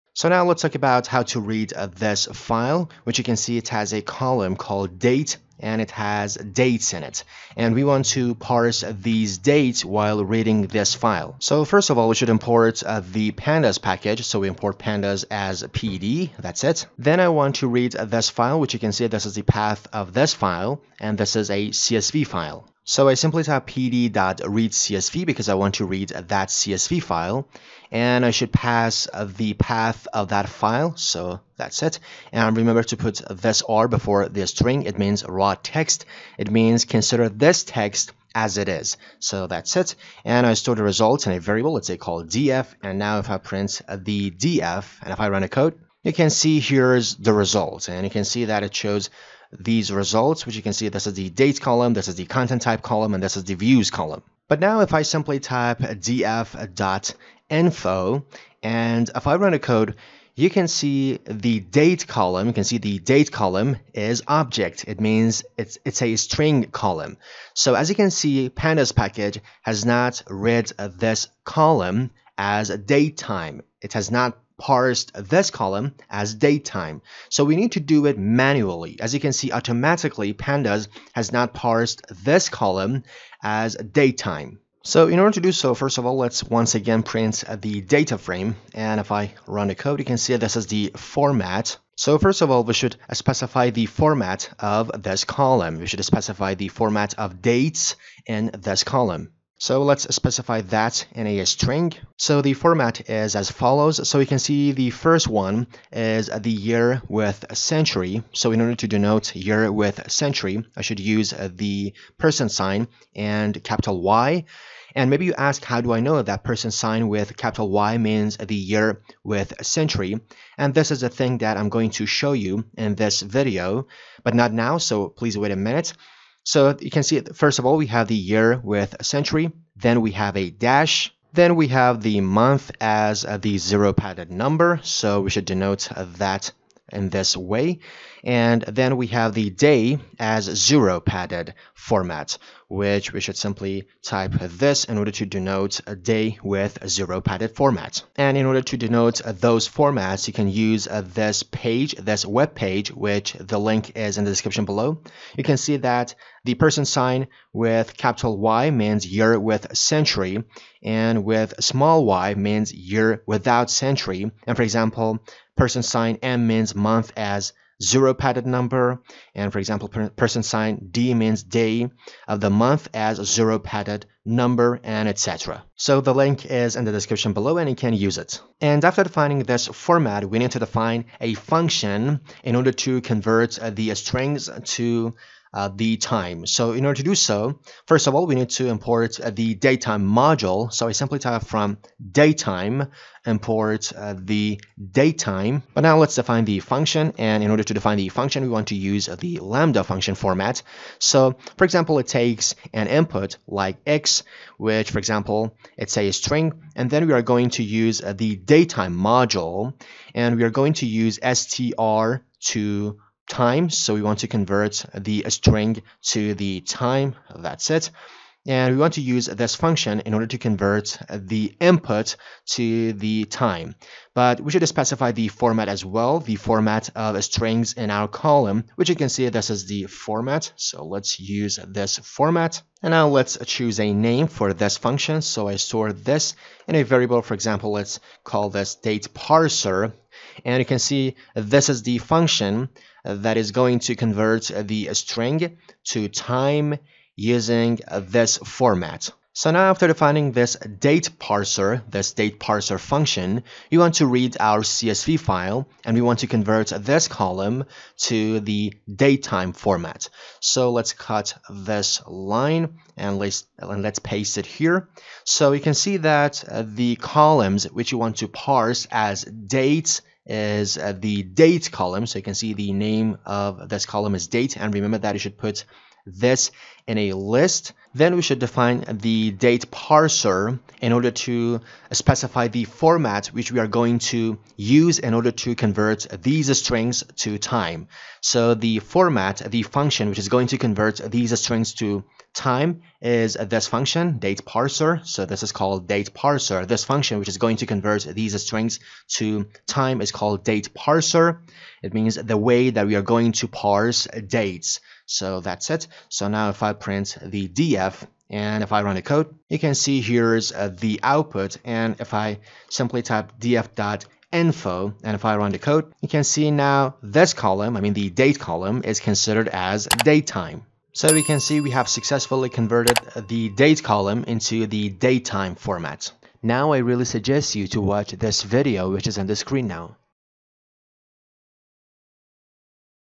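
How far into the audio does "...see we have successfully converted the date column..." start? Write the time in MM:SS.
05:21.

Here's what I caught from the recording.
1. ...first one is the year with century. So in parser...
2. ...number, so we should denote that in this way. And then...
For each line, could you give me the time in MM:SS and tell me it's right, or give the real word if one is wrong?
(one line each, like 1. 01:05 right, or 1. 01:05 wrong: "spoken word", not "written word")
1. 01:44 wrong: "order", not "parser"
2. 02:14 right.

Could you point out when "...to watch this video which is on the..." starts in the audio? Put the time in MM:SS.
05:27.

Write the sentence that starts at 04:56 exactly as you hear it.
This function which is going to convert these strings to time is called date parser.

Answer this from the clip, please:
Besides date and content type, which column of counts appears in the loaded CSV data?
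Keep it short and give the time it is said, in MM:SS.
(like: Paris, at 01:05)
views, at 00:53.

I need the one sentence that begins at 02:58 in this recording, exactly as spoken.
And after defining this format, we need to define a function in order to convert the strings to uh, the time.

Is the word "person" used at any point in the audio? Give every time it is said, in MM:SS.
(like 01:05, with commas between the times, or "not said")
01:52, 01:56, 02:36, 02:45, 02:50.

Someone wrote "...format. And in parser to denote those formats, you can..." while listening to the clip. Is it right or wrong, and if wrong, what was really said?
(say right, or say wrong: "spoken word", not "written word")
wrong: "order", not "parser".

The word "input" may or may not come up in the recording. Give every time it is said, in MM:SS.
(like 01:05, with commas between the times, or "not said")
03:22, 03:41.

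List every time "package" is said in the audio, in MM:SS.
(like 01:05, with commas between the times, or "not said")
00:13, 01:08.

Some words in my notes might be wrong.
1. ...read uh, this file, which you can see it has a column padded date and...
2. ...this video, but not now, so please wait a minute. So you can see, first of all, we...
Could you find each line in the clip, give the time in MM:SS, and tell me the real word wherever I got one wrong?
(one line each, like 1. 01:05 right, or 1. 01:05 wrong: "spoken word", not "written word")
1. 00:01 wrong: "called", not "padded"
2. 02:02 right.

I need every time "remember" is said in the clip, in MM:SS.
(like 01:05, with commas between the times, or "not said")
00:32, 04:34.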